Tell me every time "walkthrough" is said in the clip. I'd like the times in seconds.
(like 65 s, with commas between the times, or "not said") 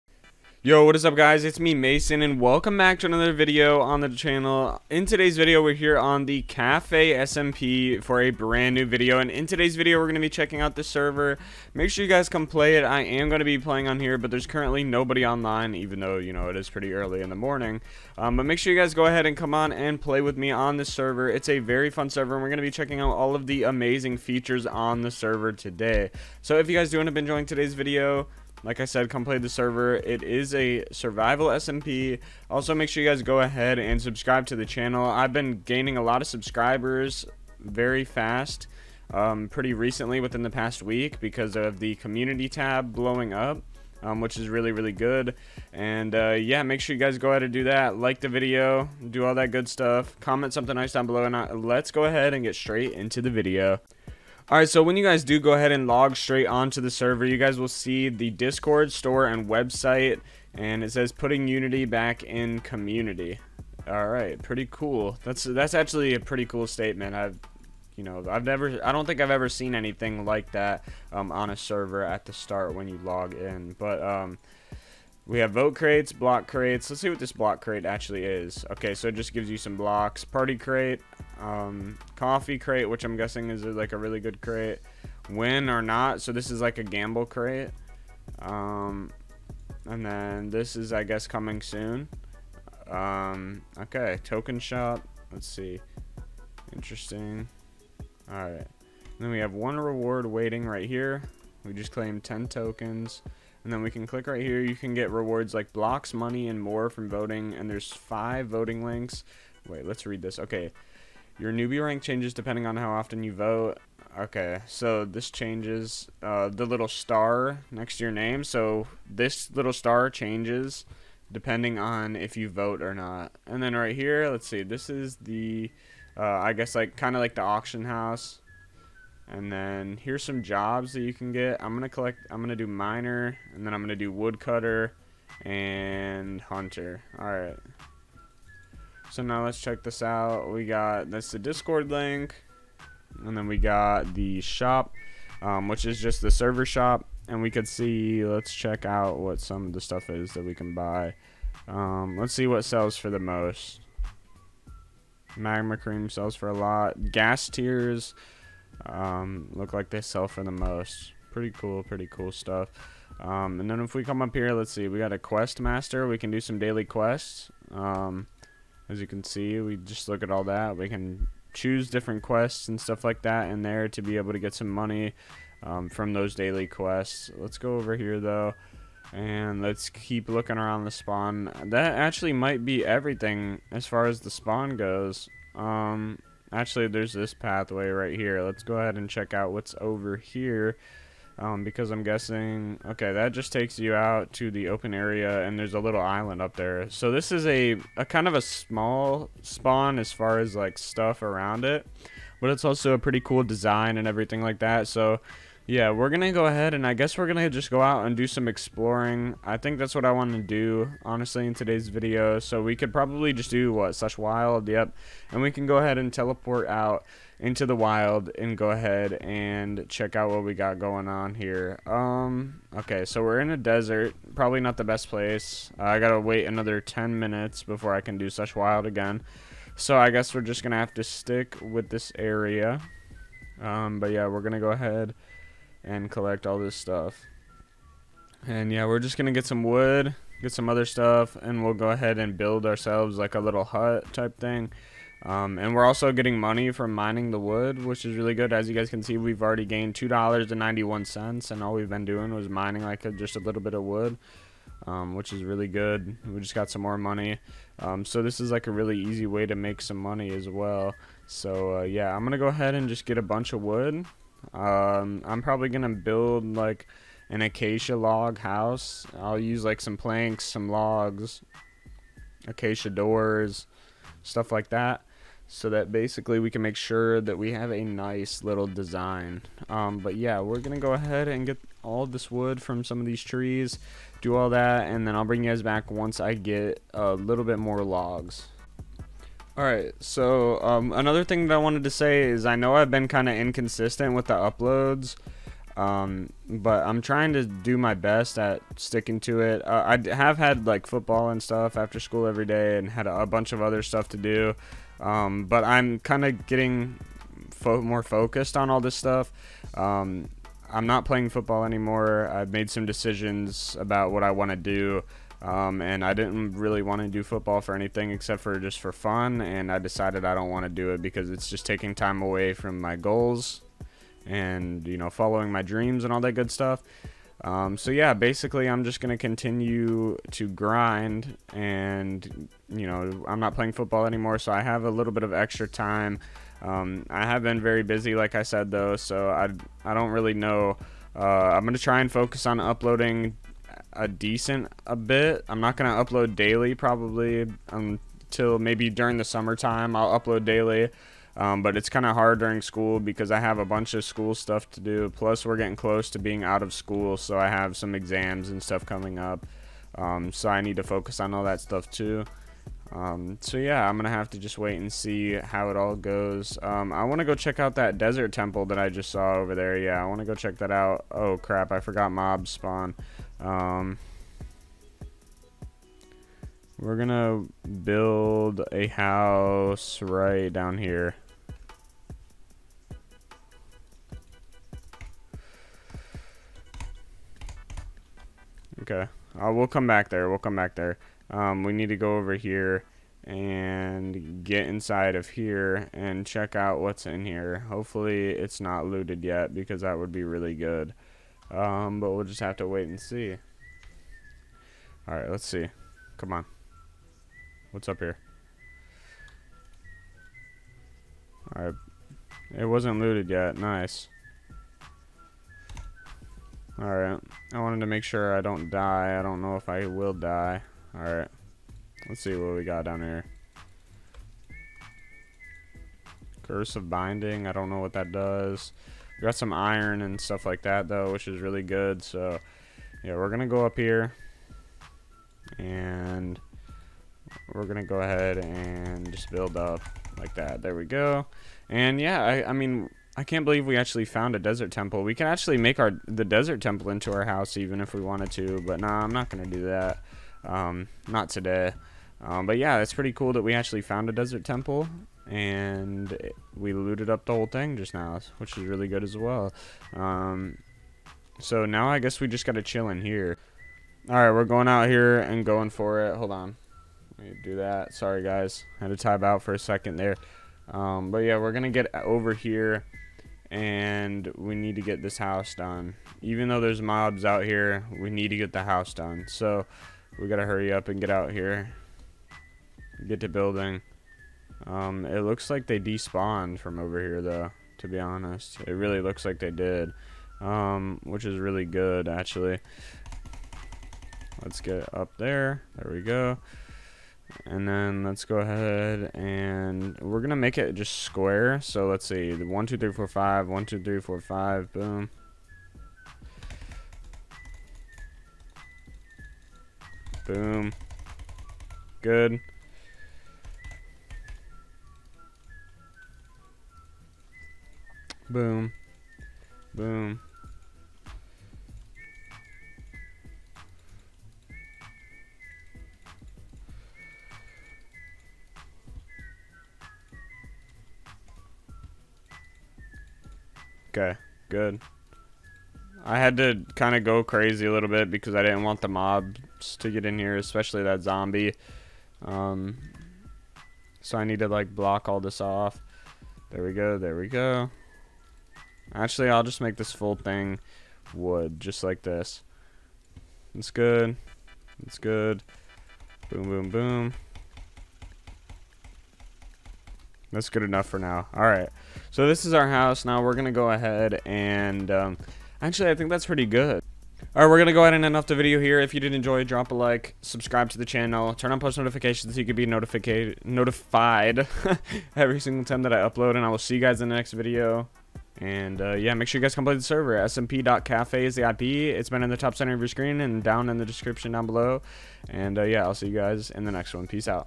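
not said.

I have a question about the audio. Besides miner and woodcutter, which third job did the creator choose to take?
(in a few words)
Hunter.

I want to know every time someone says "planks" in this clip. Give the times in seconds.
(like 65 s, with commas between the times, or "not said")
269 s.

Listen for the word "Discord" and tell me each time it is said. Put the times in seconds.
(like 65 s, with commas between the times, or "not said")
58 s, 141 s.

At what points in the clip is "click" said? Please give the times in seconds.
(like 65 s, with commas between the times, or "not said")
104 s.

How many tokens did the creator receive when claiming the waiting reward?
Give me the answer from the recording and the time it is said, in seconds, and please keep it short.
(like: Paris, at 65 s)
10, at 102 s.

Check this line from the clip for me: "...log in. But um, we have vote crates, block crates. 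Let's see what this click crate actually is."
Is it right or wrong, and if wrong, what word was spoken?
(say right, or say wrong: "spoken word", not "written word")
wrong: "block", not "click".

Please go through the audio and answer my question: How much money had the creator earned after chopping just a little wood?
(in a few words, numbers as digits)
$2.91.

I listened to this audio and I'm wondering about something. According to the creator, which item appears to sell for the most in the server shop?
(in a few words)
Ghast tears.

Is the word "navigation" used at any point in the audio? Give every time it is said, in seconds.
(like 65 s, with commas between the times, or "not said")
not said.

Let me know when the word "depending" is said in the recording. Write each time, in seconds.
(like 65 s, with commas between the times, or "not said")
112 s, 121 s.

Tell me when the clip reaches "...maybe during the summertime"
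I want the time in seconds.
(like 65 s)
348 s.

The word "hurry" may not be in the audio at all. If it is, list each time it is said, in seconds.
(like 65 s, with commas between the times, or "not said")
480 s.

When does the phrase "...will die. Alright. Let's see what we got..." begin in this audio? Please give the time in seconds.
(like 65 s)
419 s.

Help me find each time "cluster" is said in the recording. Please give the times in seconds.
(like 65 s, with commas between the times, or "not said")
not said.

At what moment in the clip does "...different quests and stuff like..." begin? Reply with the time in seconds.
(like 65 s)
171 s.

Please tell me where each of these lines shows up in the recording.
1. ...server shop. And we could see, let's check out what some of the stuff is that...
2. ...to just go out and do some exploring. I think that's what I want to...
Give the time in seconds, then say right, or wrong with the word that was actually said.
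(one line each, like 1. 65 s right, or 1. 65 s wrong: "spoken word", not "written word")
1. 146 s right
2. 207 s right.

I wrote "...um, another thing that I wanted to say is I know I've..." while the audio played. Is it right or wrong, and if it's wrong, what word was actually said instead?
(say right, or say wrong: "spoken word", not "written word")
right.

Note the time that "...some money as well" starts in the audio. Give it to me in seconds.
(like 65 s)
259 s.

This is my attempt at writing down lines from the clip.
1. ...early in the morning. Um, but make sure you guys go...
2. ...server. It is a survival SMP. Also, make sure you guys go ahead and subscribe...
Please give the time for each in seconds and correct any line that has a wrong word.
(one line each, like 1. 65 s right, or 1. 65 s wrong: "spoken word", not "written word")
1. 16 s right
2. 29 s right.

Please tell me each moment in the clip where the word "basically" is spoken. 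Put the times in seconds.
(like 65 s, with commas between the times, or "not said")
275 s, 328 s.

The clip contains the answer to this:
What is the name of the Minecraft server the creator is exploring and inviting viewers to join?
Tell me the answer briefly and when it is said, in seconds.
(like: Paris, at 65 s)
Cafe SMP, at 6 s.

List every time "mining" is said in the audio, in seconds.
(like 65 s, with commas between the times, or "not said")
246 s, 252 s.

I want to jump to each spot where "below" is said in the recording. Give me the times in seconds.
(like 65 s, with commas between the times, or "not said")
51 s, 584 s.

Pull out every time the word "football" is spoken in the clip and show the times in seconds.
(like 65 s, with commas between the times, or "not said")
300 s, 311 s, 317 s, 333 s.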